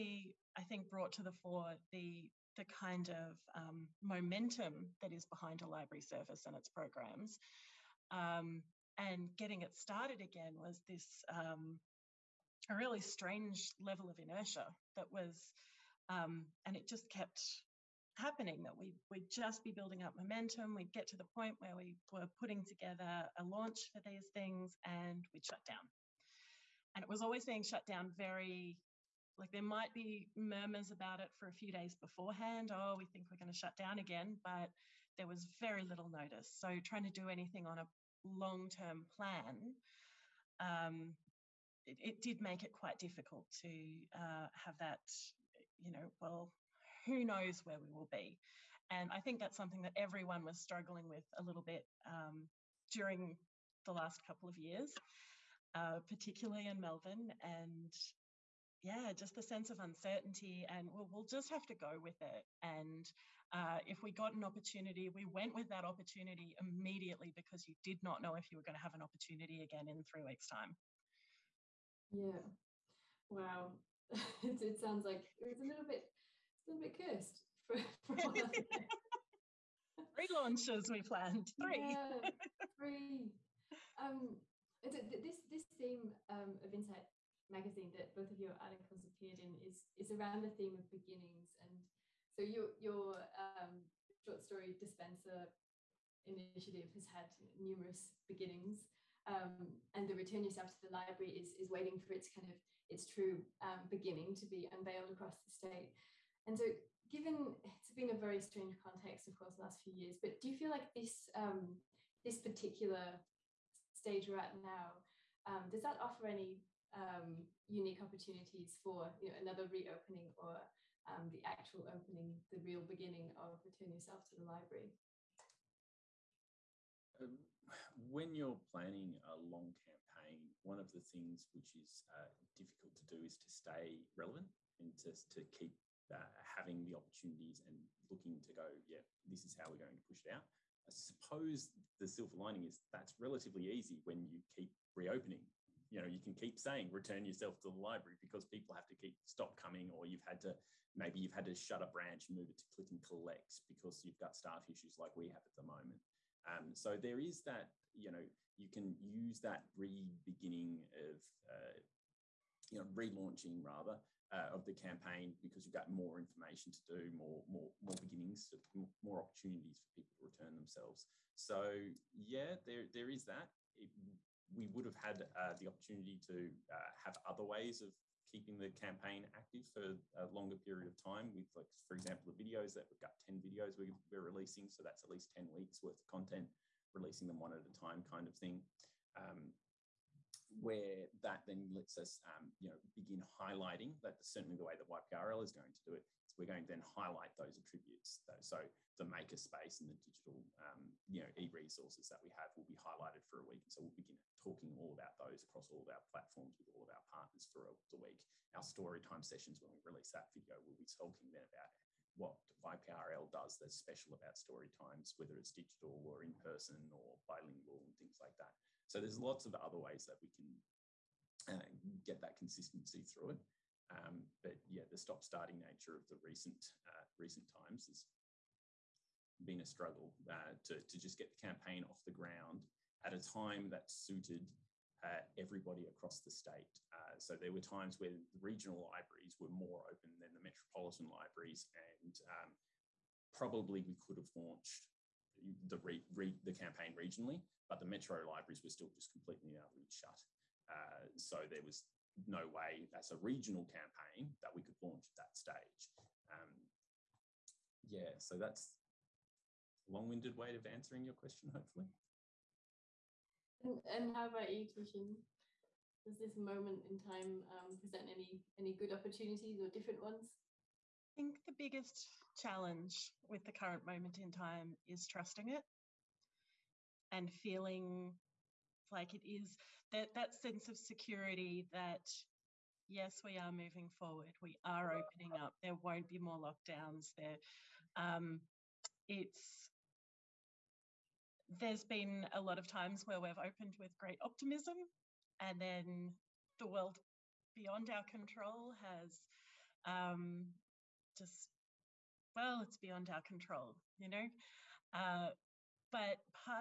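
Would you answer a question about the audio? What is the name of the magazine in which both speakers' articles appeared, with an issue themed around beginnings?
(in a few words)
INCITE.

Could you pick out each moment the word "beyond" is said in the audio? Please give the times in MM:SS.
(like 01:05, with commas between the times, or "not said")
04:57, 05:02.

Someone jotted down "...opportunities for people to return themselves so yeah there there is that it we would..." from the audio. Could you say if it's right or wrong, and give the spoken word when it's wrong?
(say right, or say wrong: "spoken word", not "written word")
right.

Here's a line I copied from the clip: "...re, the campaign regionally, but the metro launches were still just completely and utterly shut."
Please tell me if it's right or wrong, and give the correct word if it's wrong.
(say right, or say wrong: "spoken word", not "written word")
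wrong: "libraries", not "launches".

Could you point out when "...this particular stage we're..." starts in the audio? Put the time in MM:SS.
01:52.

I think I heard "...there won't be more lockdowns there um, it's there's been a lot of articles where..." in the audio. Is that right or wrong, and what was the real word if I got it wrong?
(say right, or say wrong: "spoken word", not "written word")
wrong: "times", not "articles".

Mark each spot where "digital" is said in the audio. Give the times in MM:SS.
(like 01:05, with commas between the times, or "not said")
03:19, 03:35.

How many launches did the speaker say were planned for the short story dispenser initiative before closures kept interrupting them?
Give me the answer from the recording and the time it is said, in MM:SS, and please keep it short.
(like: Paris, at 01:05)
3, at 01:20.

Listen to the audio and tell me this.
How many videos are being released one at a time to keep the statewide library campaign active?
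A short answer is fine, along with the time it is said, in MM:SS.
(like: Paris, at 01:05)
10, at 03:03.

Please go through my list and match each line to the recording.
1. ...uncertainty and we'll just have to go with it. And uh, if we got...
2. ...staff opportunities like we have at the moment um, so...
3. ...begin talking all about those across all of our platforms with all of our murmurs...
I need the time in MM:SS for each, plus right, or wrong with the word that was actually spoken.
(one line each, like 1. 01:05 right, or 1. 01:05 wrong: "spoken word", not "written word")
1. 00:59 right
2. 02:34 wrong: "issues", not "opportunities"
3. 03:23 wrong: "partners", not "murmurs".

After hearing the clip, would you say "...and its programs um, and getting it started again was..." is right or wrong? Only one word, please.
right.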